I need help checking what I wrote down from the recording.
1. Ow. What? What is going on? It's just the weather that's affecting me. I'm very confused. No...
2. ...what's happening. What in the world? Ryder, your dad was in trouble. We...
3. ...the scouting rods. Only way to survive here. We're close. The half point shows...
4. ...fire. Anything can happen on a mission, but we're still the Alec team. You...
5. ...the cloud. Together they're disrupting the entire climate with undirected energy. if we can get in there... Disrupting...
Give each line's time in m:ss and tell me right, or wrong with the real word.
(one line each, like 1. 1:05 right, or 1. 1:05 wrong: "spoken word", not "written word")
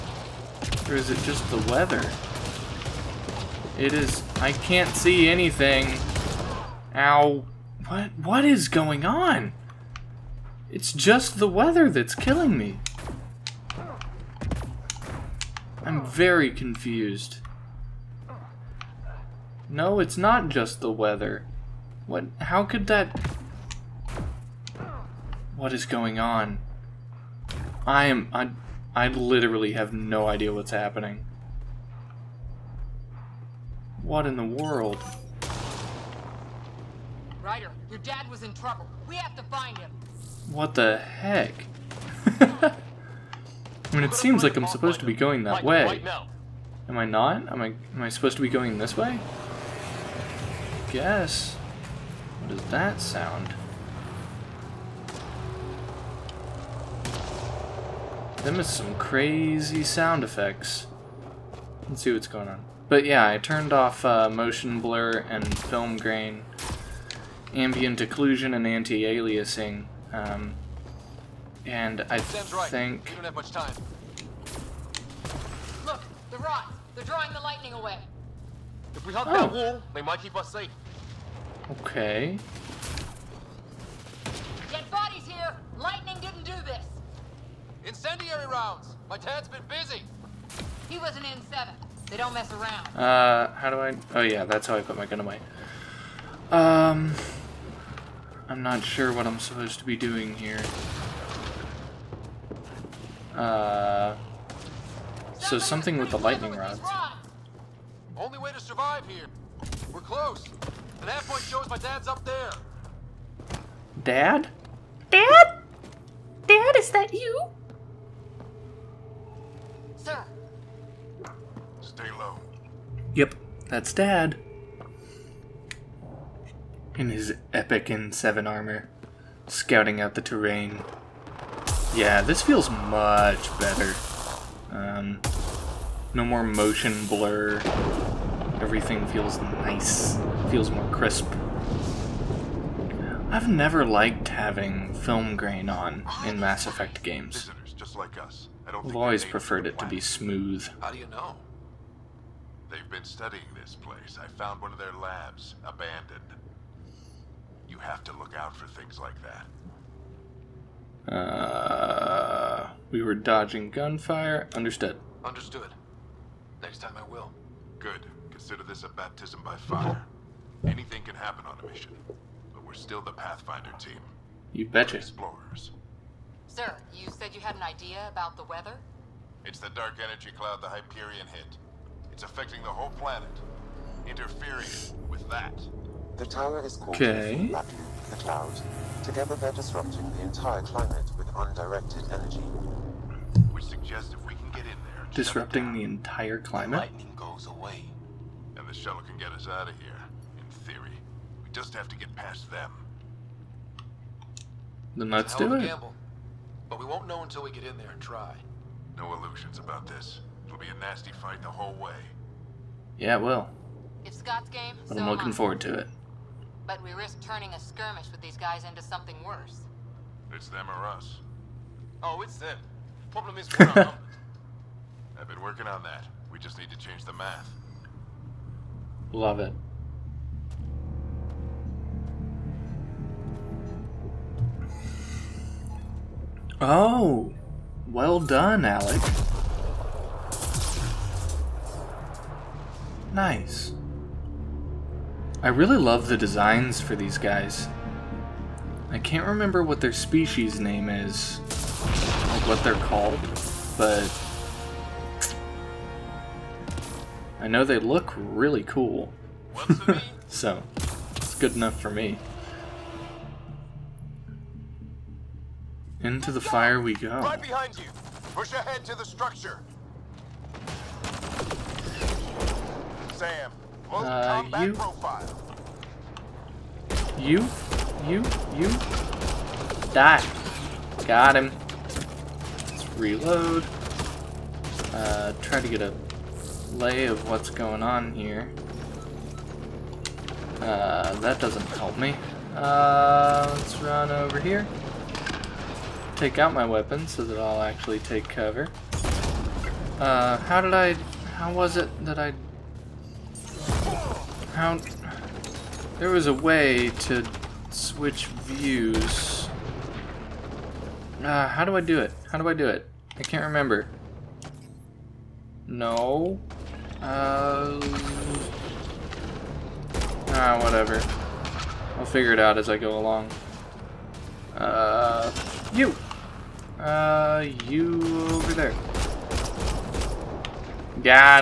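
1. 0:06 wrong: "killing", not "affecting"
2. 0:30 right
3. 1:46 wrong: "lightning", not "scouting"
4. 2:49 wrong: "Pathfinder", not "Alec"
5. 3:08 right.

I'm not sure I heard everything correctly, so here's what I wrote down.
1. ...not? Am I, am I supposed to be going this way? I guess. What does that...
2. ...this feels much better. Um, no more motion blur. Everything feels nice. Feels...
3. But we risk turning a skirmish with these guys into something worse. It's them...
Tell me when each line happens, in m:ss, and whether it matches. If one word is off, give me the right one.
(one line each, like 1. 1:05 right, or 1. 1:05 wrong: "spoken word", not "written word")
1. 0:47 right
2. 2:12 right
3. 3:36 right.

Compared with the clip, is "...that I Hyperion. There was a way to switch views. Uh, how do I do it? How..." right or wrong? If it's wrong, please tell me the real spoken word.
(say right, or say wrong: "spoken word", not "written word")
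wrong: "Count", not "Hyperion".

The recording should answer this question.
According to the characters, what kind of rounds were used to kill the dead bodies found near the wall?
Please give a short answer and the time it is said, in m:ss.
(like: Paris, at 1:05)
Incendiary rounds, at 1:27.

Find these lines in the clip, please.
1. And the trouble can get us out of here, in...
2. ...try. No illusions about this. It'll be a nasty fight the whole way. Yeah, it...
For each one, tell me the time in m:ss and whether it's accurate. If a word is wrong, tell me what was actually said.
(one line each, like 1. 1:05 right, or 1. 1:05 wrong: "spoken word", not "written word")
1. 3:18 wrong: "shuttle", not "trouble"
2. 3:28 right.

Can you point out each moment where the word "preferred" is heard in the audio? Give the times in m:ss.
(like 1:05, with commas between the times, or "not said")
2:29.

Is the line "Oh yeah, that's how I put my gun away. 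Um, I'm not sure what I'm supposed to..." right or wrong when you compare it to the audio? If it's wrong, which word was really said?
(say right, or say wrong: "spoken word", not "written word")
right.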